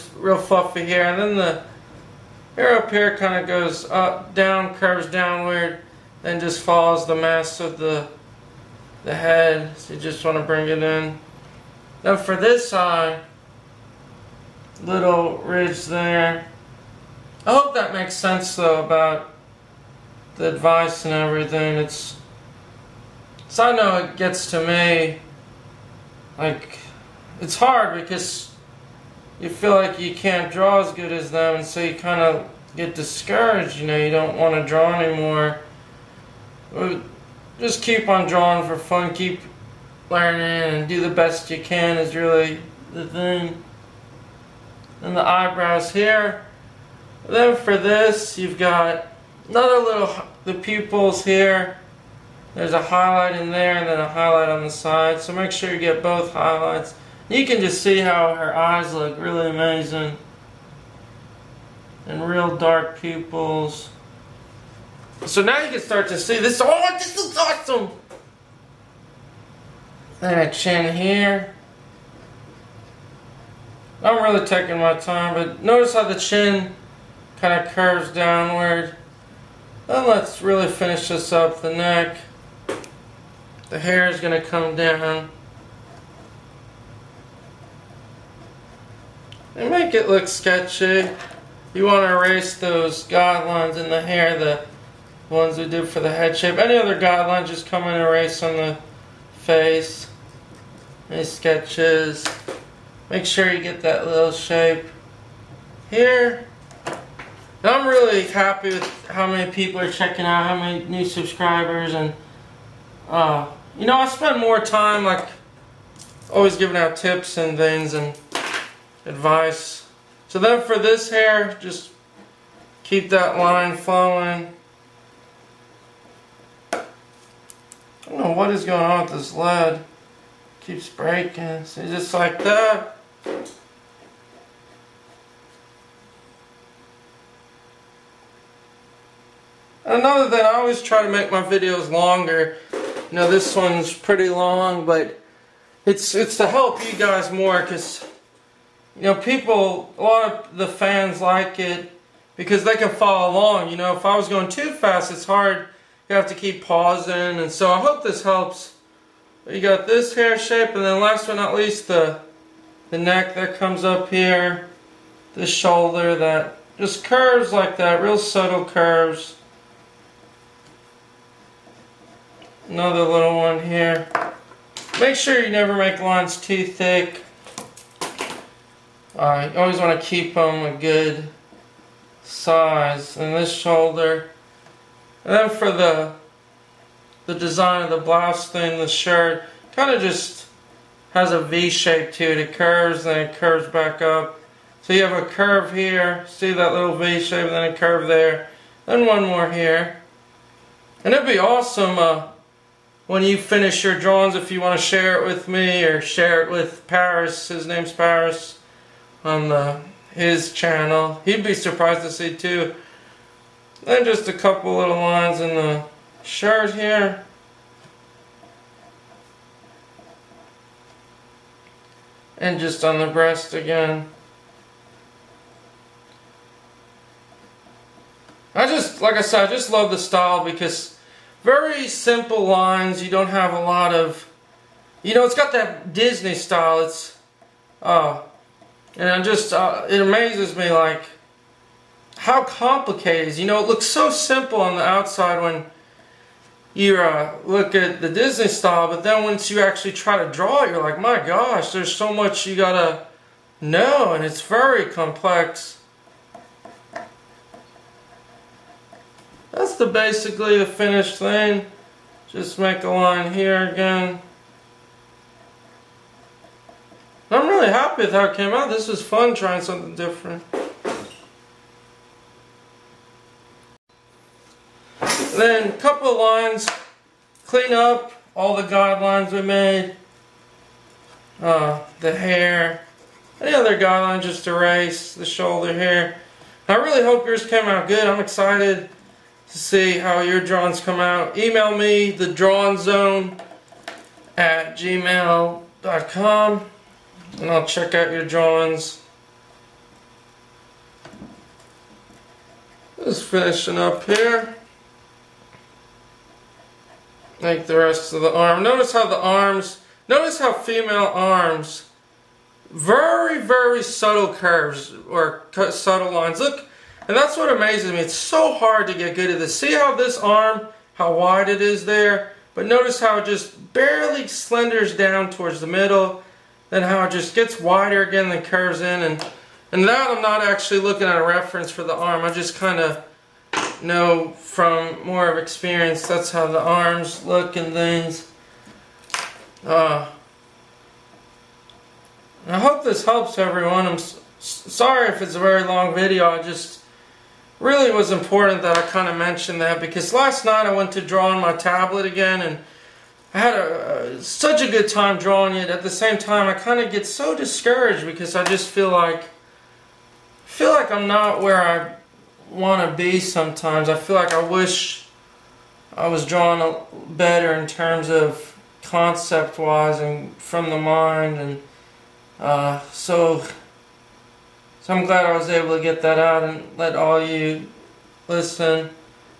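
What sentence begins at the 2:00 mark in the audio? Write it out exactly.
So then for this hair, just keep that line flowing.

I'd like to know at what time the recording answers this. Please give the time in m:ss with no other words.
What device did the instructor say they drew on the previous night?
5:51.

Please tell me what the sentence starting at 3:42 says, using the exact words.
And just on the breast again.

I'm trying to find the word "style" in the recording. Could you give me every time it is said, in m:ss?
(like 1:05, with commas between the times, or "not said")
3:49, 3:56, 4:08.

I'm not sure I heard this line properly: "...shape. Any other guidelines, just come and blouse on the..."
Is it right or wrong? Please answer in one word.
wrong.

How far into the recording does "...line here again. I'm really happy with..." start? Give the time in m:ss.
4:22.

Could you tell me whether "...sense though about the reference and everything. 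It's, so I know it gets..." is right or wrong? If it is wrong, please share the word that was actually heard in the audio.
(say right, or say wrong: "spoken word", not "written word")
wrong: "advice", not "reference".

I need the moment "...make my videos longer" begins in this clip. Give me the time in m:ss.
2:21.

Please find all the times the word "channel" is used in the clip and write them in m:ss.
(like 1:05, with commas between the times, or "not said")
3:30.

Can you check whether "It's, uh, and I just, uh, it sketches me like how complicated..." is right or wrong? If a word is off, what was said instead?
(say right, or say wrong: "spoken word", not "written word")
wrong: "amazes", not "sketches".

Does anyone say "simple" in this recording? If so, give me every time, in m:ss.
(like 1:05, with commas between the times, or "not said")
3:51, 4:04.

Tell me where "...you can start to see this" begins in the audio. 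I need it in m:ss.
1:05.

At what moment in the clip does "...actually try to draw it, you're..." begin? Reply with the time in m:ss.
4:09.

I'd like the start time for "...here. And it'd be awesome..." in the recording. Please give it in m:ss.
3:19.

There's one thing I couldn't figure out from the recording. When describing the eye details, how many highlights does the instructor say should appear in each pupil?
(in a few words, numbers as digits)
2.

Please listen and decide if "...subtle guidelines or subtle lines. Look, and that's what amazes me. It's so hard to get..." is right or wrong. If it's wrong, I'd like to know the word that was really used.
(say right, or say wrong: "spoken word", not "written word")
wrong: "curves", not "guidelines".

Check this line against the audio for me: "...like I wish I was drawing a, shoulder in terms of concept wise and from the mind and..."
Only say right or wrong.
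wrong.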